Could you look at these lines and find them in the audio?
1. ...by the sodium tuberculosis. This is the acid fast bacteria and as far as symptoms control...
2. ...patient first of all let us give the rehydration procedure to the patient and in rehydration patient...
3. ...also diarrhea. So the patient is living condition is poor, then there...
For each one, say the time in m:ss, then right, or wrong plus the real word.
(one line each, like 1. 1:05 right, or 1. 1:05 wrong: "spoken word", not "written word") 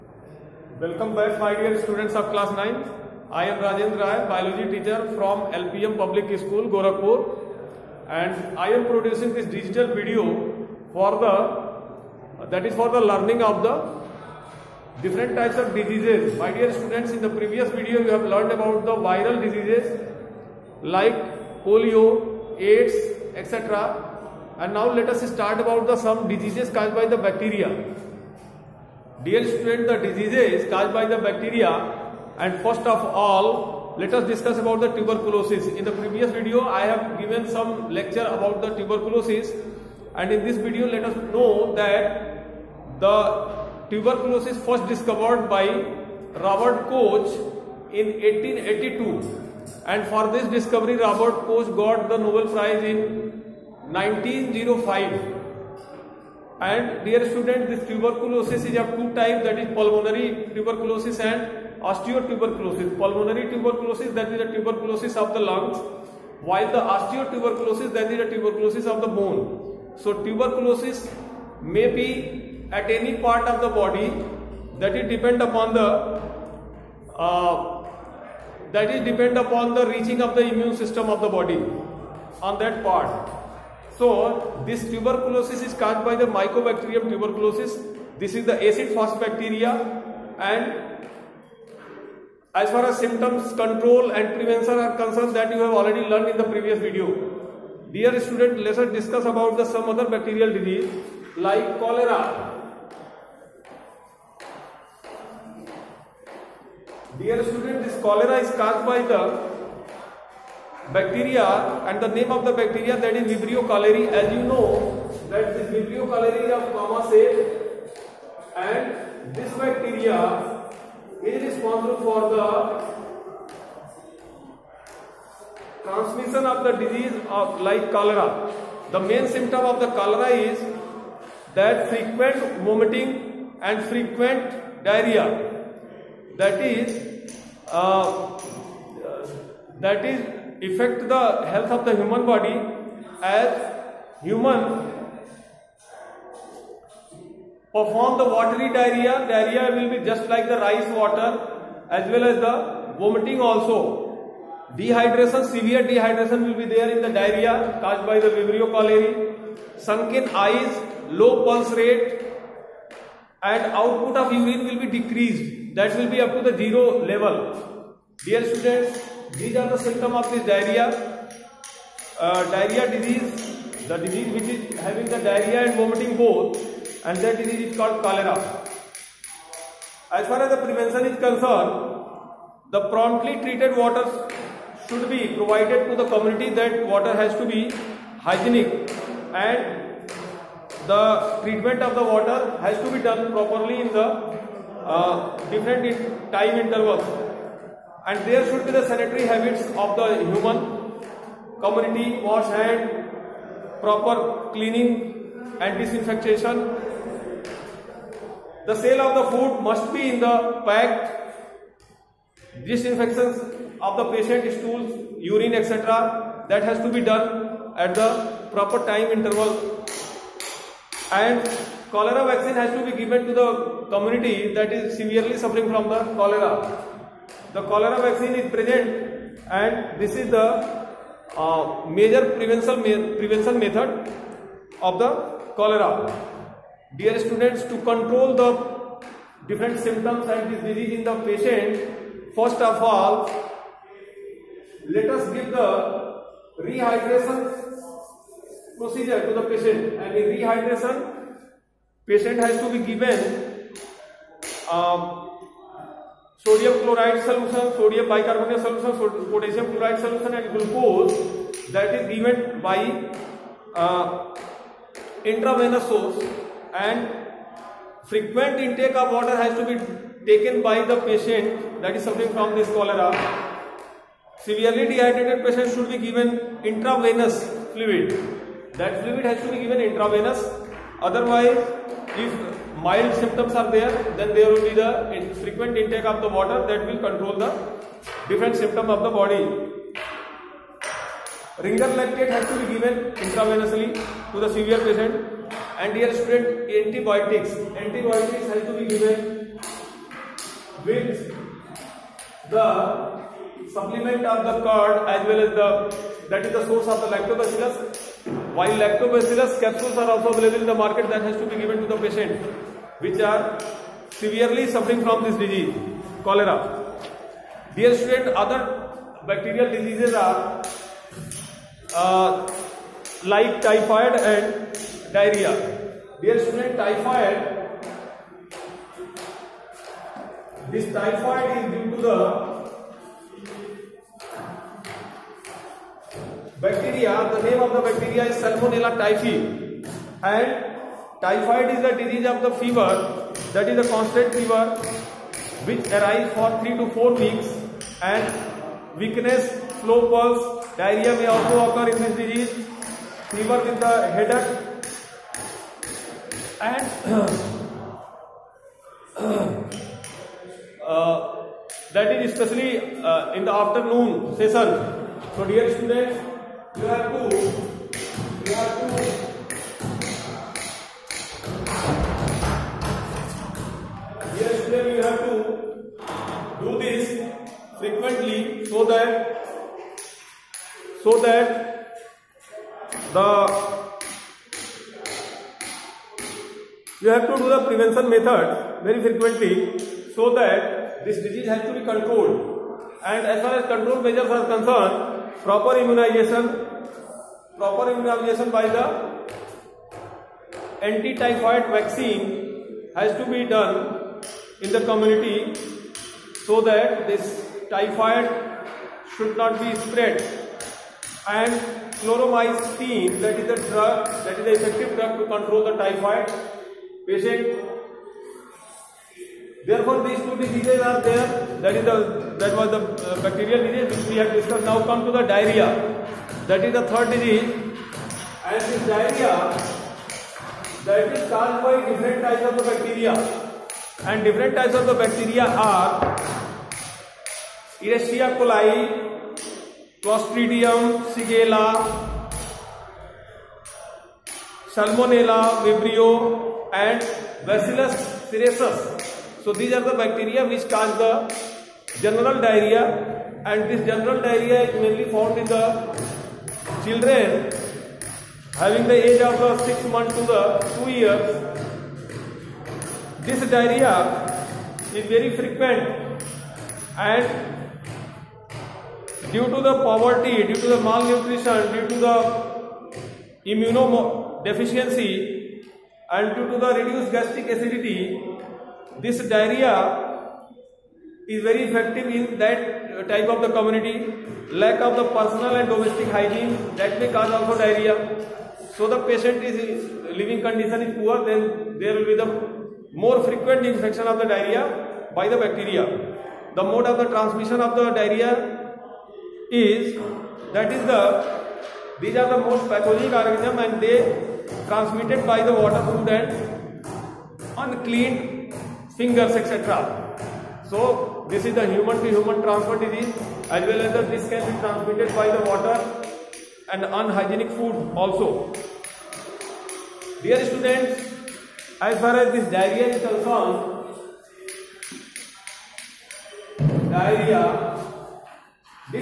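1. 1:26 wrong: "mycobacterium", not "sodium"
2. 4:01 right
3. 8:07 right.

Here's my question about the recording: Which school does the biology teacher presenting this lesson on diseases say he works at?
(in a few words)
LPM Public School.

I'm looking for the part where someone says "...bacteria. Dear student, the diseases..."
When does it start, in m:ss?
0:27.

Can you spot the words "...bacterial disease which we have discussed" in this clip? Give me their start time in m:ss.
7:03.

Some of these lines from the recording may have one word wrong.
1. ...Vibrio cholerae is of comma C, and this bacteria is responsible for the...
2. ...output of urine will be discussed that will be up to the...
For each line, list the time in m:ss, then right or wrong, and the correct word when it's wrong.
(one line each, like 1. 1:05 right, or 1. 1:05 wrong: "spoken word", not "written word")
1. 1:55 right
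2. 2:43 wrong: "decreased", not "discussed".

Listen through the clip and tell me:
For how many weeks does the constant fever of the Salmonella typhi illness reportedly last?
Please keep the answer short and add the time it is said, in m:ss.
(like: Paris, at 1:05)
3 to 4 weeks, at 5:46.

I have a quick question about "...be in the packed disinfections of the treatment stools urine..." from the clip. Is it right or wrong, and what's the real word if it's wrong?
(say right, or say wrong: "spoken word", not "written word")
wrong: "patient", not "treatment".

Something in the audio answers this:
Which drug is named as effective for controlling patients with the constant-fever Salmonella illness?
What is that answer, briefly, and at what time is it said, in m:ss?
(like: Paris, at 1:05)
chloromycin, at 6:52.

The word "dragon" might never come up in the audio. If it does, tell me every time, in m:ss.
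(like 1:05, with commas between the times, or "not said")
not said.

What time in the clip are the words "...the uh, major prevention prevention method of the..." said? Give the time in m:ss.
3:50.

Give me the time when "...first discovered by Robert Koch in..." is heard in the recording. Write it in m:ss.
0:44.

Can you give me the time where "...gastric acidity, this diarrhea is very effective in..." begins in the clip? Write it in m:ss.
7:57.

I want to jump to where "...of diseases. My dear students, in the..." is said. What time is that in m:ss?
0:15.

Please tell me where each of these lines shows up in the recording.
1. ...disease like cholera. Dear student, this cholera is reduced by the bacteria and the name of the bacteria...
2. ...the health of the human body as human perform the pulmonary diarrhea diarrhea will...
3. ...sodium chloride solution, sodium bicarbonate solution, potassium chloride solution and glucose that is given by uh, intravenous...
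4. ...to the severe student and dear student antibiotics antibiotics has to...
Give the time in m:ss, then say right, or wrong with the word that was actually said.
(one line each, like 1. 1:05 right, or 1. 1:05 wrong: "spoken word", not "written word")
1. 1:40 wrong: "caused", not "reduced"
2. 2:21 wrong: "watery", not "pulmonary"
3. 4:16 right
4. 4:54 wrong: "patient", not "student".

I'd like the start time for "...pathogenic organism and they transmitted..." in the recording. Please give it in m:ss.
8:22.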